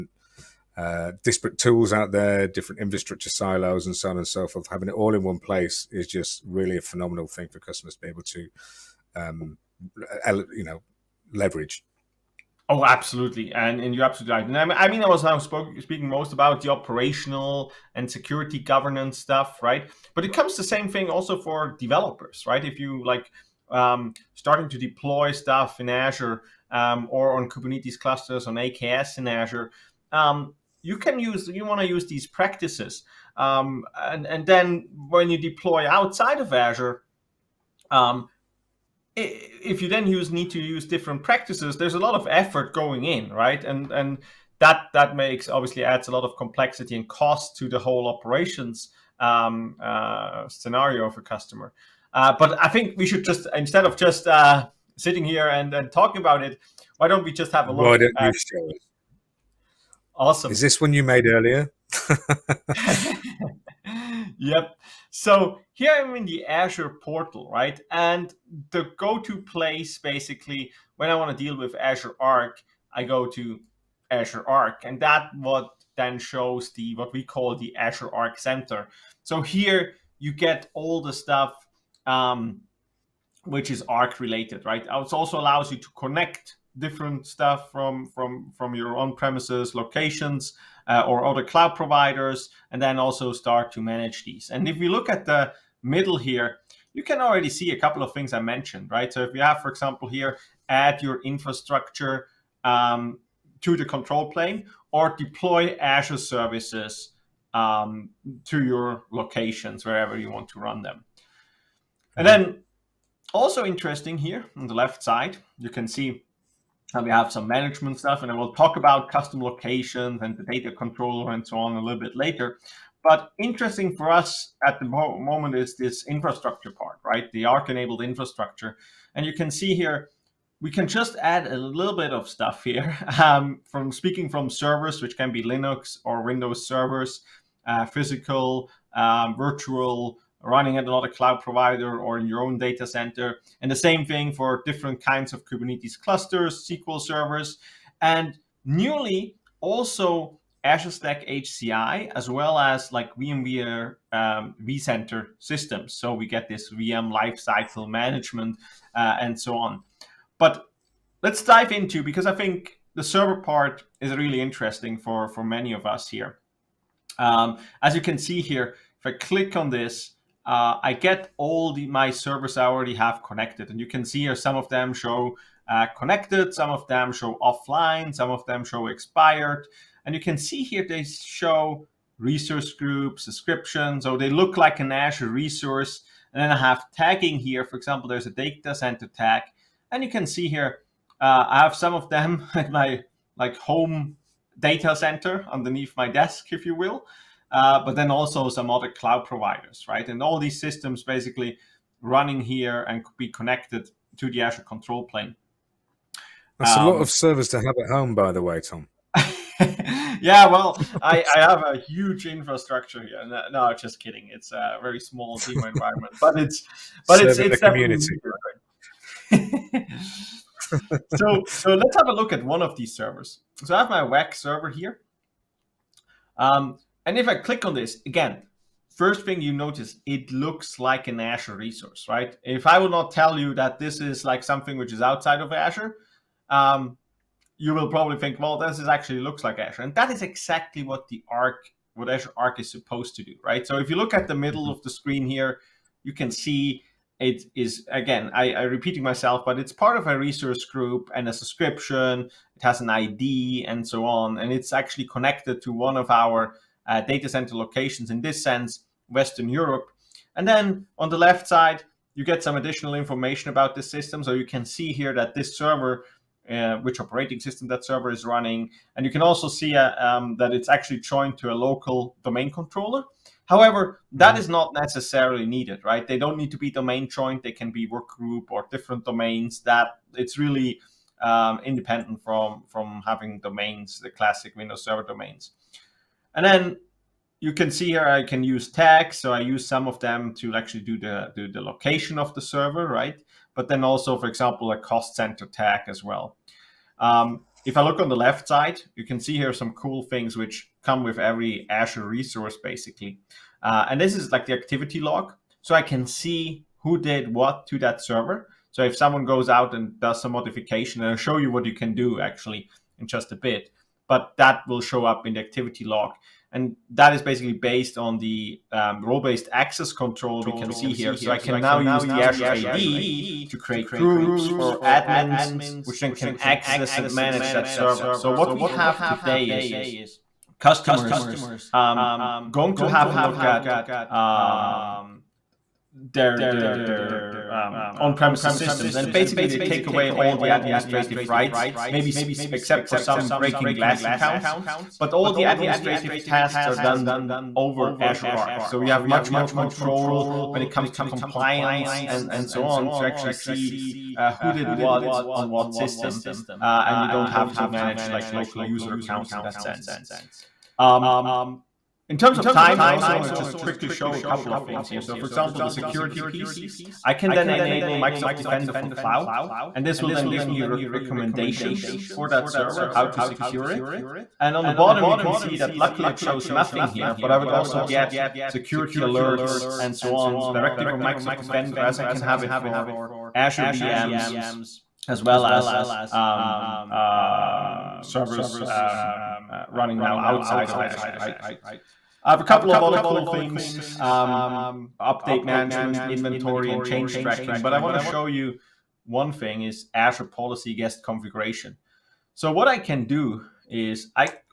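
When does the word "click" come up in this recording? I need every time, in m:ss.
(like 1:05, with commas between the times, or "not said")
2:49, 3:47.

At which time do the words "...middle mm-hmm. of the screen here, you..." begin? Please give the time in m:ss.
4:04.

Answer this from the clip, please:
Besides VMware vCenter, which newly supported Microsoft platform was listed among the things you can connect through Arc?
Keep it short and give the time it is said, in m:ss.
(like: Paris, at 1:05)
Azure Stack HCI, at 2:30.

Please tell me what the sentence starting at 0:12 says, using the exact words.
Oh, absolutely, and, and you're absolutely right.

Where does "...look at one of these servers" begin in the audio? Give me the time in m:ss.
3:42.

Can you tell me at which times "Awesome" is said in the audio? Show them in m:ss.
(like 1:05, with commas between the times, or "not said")
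1:00.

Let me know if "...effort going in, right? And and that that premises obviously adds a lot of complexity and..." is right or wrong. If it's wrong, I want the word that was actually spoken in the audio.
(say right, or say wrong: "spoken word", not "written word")
wrong: "makes", not "premises".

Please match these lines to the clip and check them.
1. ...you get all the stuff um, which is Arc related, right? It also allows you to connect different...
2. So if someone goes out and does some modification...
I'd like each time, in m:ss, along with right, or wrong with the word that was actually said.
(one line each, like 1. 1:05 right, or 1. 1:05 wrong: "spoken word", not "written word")
1. 1:20 right
2. 5:08 right.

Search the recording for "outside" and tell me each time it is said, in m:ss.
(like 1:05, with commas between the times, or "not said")
0:35, 3:55, 6:30.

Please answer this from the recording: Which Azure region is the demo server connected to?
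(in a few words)
Western Europe.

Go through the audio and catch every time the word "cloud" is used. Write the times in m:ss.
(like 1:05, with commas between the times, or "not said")
1:31, 2:21, 3:18, 6:08.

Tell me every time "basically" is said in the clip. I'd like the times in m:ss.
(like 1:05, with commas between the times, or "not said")
1:09, 3:21, 5:02, 5:17, 5:39.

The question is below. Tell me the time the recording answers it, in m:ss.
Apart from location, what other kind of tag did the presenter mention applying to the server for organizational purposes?
4:54.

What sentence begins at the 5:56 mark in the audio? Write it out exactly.
Uh, and you don't have to manage like local user accounts in that sense.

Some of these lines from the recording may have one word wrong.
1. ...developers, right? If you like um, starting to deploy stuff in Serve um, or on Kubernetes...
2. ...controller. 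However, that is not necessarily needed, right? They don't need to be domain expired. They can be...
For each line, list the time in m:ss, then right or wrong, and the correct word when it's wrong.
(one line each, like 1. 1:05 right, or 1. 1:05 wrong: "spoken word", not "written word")
1. 0:21 wrong: "Azure", not "Serve"
2. 4:32 wrong: "joined", not "expired".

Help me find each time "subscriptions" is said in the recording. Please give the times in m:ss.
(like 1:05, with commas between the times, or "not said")
3:03, 4:11.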